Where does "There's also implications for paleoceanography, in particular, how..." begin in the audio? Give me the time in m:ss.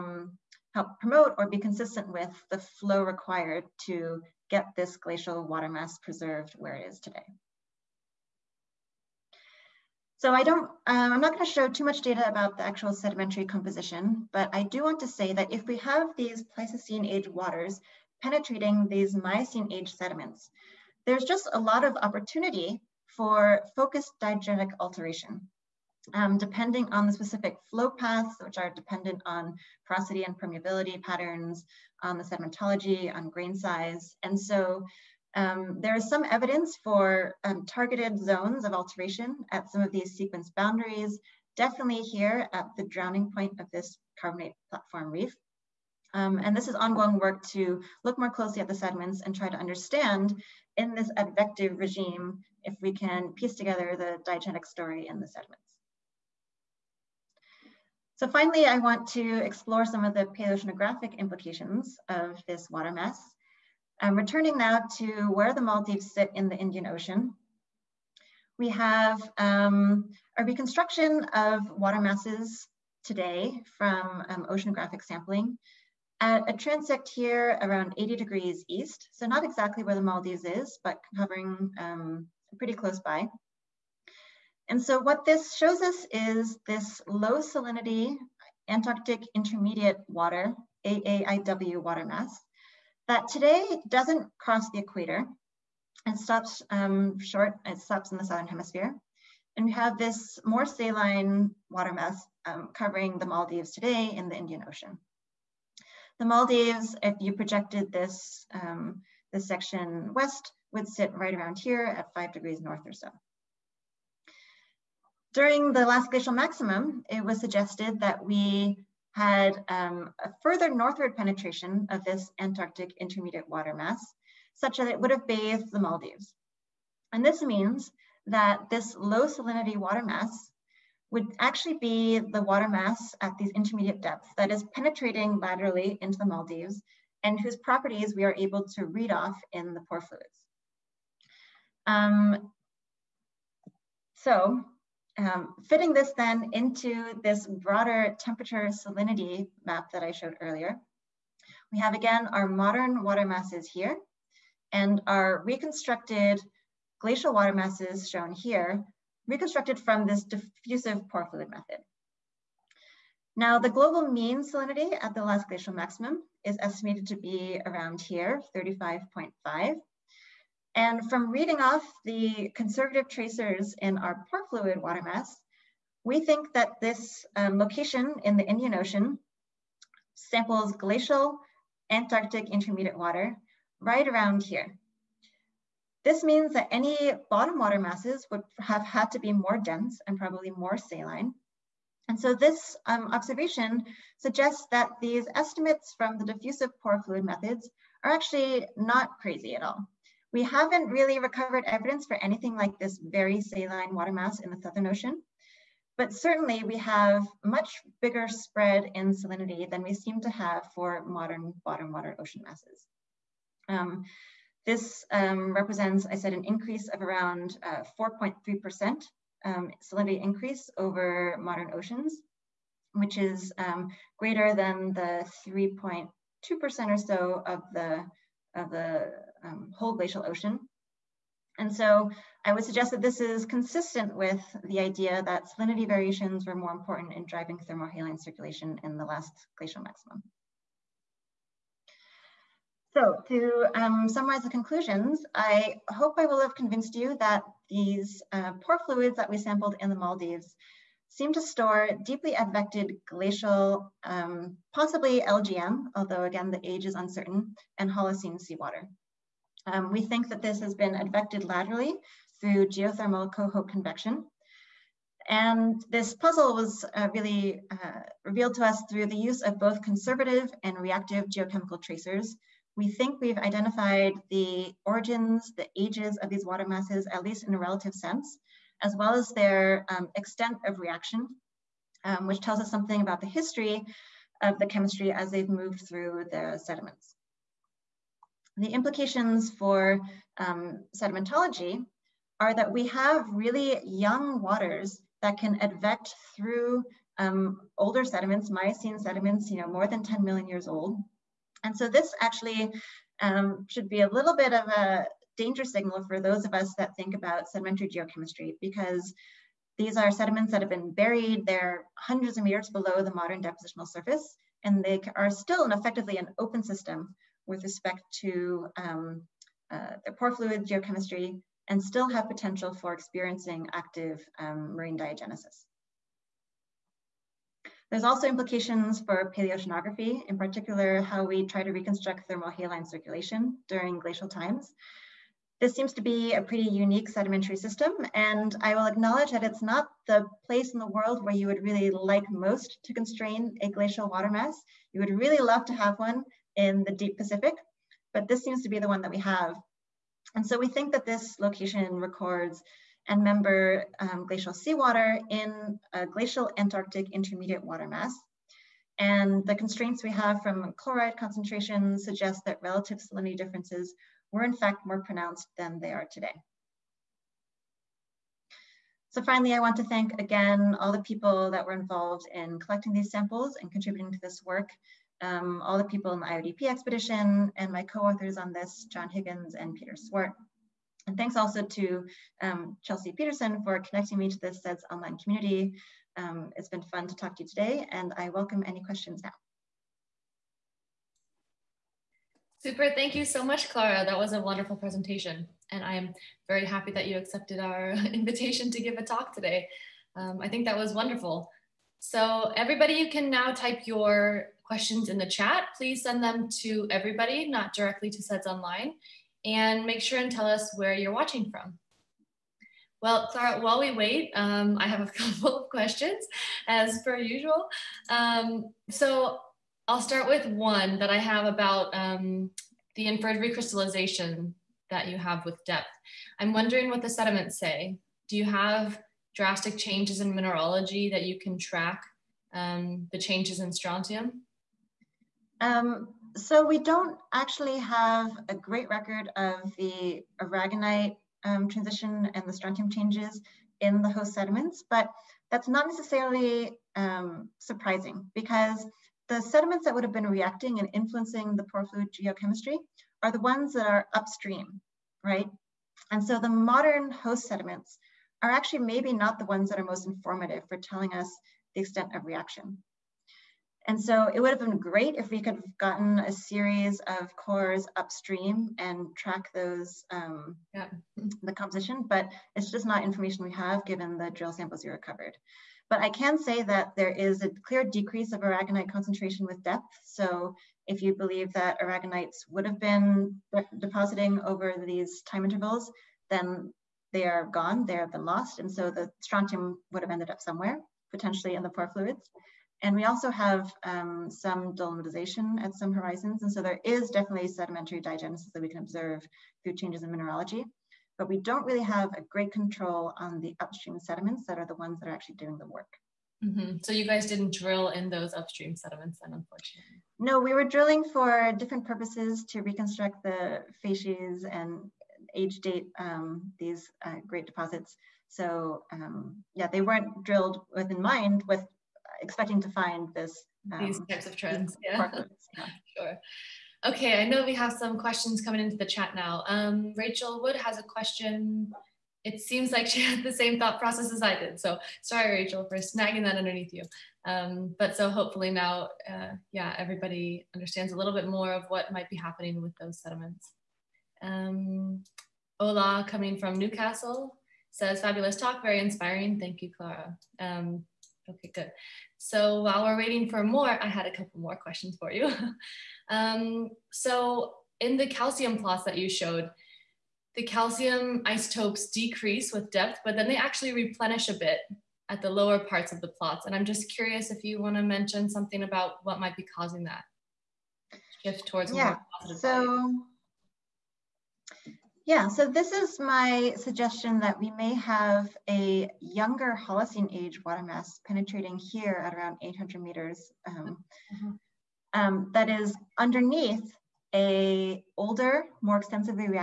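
5:27.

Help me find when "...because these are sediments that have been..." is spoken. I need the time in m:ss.
5:08.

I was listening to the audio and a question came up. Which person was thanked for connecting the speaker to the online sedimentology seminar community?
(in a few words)
Chelsea Peterson.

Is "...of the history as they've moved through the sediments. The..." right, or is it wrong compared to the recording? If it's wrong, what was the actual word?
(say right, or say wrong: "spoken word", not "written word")
wrong: "chemistry", not "history".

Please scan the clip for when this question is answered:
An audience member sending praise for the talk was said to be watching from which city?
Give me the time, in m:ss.
9:06.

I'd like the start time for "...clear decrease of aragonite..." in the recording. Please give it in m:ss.
7:57.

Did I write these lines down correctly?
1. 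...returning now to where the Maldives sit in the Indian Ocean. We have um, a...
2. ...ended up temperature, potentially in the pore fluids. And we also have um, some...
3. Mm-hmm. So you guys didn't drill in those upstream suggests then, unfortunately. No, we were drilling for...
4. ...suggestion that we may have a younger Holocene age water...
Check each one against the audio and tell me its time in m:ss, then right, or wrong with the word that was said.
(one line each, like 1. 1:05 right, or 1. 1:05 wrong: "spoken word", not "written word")
1. 1:04 right
2. 8:10 wrong: "somewhere", not "temperature"
3. 8:26 wrong: "sediments", not "suggests"
4. 9:36 right.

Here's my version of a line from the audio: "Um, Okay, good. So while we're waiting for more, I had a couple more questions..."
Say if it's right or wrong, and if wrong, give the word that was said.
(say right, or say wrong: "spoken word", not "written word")
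right.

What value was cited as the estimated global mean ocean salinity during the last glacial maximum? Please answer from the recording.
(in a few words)
35.5.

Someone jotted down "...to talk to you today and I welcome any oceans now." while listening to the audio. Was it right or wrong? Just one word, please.
wrong.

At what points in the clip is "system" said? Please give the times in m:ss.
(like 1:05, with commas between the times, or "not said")
5:16, 5:37.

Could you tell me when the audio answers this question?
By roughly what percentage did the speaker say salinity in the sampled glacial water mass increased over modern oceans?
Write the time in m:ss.
3:37.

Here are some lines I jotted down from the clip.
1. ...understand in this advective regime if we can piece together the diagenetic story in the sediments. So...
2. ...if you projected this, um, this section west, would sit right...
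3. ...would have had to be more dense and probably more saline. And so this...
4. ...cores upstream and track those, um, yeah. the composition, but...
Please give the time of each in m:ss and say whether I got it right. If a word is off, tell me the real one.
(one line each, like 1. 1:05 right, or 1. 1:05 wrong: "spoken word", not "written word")
1. 0:49 right
2. 1:47 right
3. 3:08 right
4. 7:47 right.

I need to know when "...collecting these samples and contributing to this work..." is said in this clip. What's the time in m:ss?
6:12.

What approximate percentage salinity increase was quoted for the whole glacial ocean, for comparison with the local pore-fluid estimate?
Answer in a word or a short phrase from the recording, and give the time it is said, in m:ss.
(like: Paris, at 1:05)
3.2%, at 3:45.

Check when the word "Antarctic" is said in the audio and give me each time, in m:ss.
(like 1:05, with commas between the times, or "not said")
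1:28, 2:02, 3:01, 5:56.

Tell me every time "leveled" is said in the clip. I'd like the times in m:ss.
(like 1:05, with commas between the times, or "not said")
not said.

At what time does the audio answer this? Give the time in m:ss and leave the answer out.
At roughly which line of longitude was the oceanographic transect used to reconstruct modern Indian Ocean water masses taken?
1:17.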